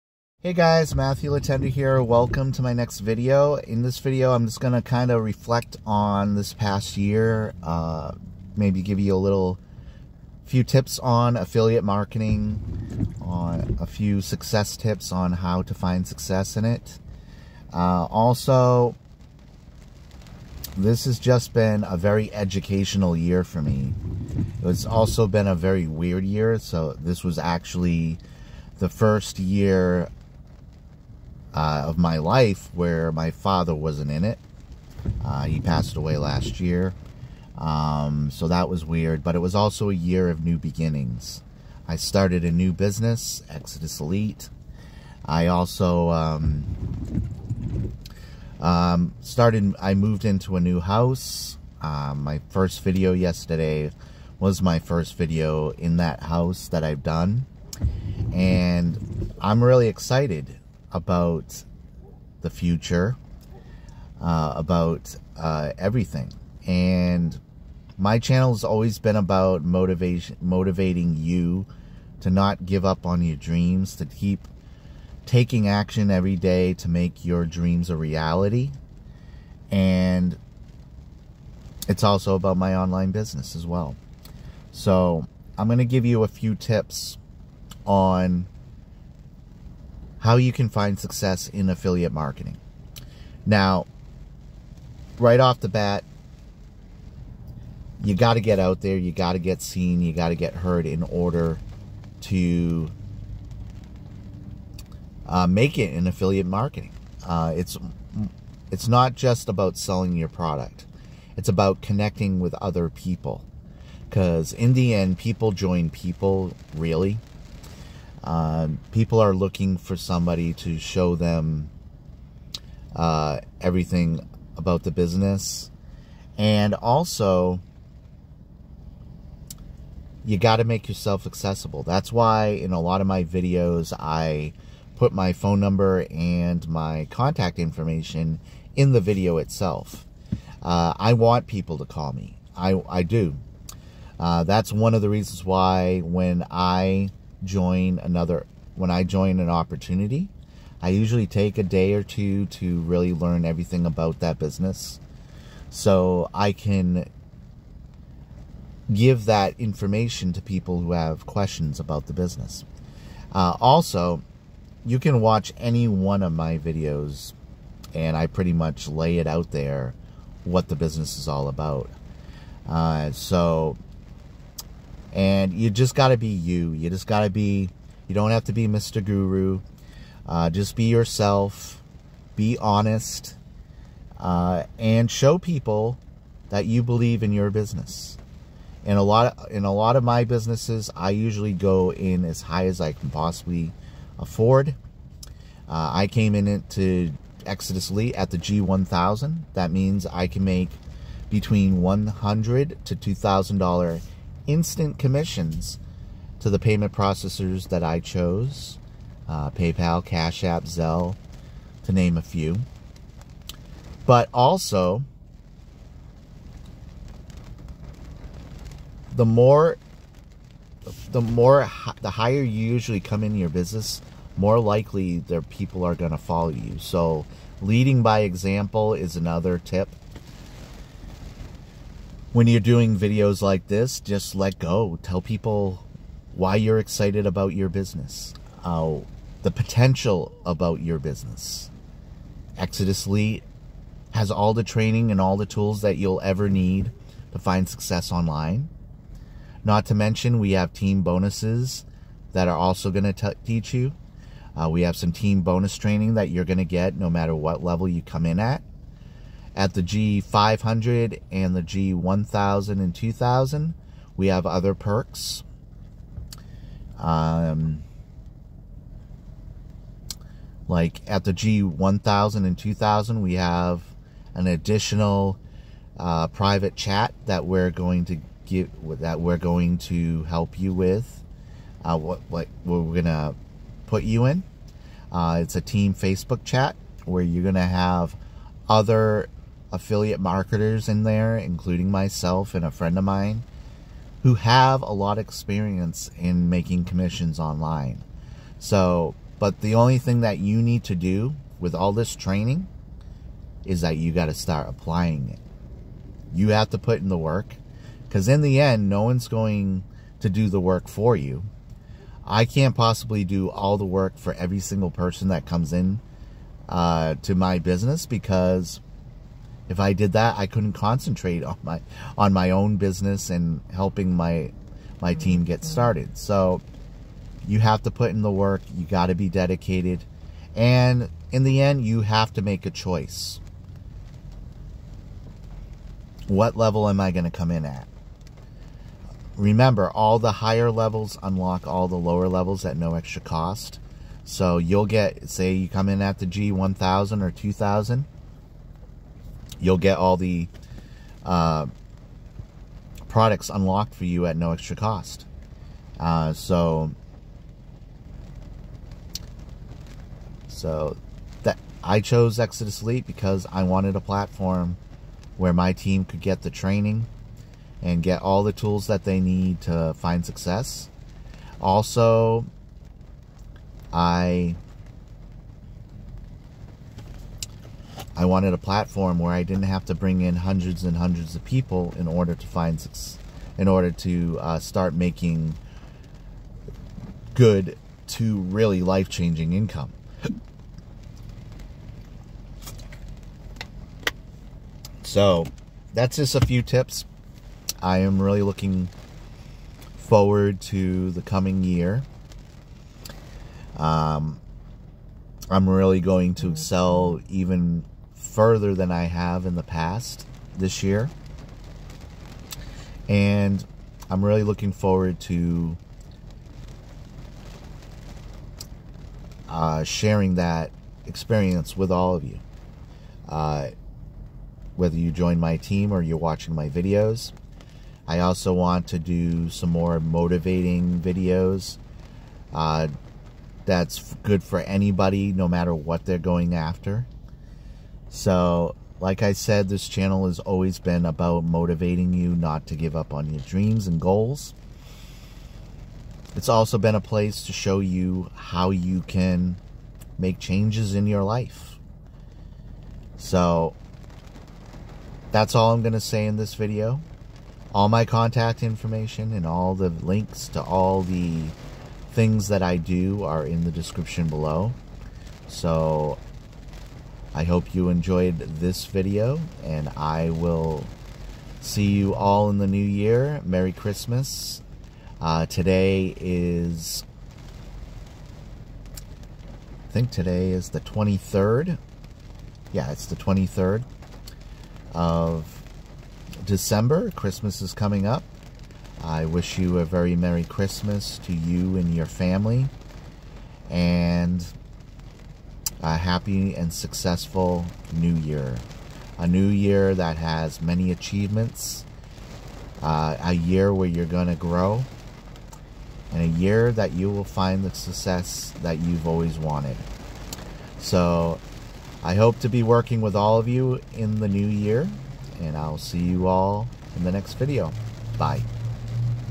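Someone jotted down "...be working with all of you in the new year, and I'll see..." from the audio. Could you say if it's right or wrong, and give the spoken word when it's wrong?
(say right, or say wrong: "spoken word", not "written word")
right.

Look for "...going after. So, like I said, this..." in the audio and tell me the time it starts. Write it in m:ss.
7:16.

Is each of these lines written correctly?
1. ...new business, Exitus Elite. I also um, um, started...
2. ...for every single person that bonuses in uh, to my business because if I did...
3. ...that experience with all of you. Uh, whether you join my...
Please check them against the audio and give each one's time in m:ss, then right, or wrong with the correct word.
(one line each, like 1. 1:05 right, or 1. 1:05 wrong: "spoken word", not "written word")
1. 0:42 right
2. 5:14 wrong: "comes", not "bonuses"
3. 7:00 right.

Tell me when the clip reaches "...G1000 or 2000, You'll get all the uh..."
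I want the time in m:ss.
5:46.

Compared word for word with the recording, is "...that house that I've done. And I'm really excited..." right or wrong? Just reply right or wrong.
right.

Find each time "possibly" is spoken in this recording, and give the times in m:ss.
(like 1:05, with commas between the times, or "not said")
3:13, 5:12.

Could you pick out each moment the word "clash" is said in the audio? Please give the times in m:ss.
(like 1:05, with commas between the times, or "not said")
not said.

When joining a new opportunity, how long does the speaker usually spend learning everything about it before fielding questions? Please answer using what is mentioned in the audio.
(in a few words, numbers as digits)
a day or two.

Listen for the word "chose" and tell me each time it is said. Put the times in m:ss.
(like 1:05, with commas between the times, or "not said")
3:27, 6:02.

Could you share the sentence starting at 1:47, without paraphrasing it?
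Uh, it's it's not just about selling your product; it's about connecting with other people.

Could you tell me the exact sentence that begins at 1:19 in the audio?
And it's also about my online business as well.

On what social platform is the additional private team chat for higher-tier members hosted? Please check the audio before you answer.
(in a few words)
Facebook.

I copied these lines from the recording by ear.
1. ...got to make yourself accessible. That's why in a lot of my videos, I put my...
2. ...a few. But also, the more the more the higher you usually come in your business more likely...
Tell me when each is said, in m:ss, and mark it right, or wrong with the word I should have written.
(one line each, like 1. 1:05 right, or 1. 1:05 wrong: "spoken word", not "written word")
1. 2:10 right
2. 3:32 right.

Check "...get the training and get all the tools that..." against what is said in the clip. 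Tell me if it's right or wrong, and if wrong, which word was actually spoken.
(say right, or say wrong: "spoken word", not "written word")
right.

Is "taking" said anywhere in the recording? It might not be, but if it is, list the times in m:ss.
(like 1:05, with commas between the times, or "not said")
1:15.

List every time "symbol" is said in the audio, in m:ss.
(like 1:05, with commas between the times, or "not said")
not said.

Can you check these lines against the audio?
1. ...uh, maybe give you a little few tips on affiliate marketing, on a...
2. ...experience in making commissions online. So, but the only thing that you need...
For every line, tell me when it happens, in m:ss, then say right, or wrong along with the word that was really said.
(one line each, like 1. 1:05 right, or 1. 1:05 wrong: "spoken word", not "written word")
1. 0:07 right
2. 4:55 right.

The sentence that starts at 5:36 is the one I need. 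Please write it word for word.
What level am I going to come in at?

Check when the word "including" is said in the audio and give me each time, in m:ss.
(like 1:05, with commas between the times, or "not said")
4:51.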